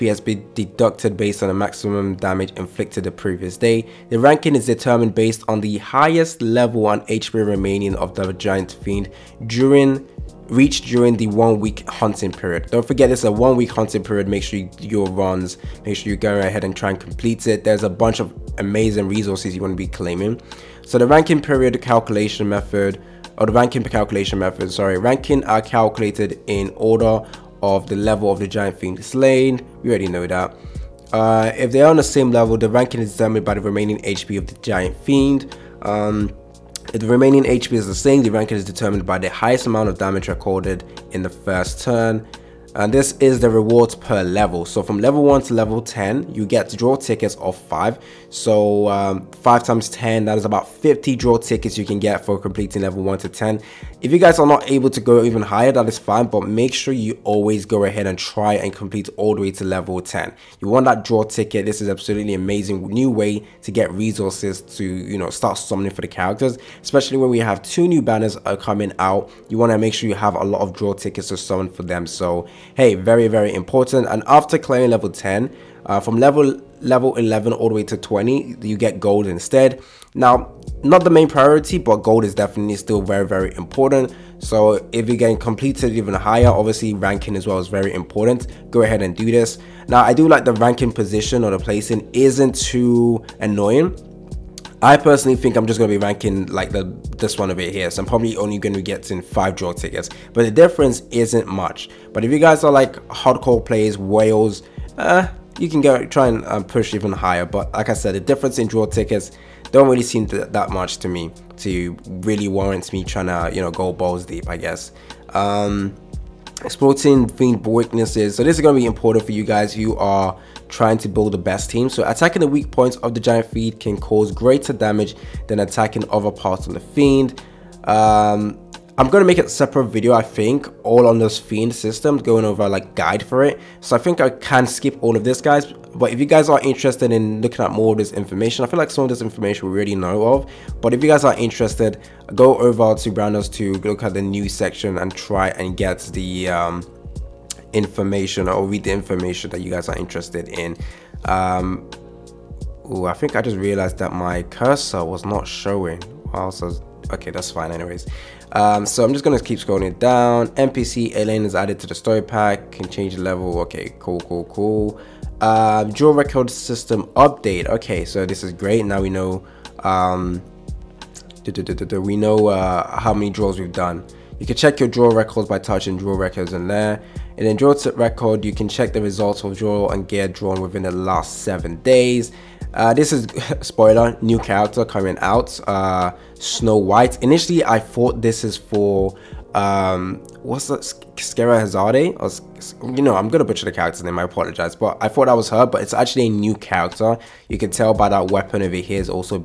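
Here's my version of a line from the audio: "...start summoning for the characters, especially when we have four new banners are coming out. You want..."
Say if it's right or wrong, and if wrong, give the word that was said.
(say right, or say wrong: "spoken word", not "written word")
wrong: "two", not "four".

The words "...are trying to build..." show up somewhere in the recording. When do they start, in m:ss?
1:59.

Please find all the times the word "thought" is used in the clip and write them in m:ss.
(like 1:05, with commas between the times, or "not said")
3:07, 3:15.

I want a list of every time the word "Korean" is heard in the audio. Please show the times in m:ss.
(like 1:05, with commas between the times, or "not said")
not said.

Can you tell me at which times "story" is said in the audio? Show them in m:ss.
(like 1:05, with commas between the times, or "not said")
2:41.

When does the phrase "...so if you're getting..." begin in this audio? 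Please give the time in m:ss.
1:24.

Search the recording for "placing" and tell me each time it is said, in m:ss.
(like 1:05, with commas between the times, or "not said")
1:31.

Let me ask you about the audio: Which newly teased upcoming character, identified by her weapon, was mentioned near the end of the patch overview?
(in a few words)
Snow White.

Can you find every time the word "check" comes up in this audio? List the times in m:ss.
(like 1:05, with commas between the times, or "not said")
2:54, 2:58.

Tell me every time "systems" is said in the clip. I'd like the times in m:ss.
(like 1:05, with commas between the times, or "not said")
2:11, 2:46.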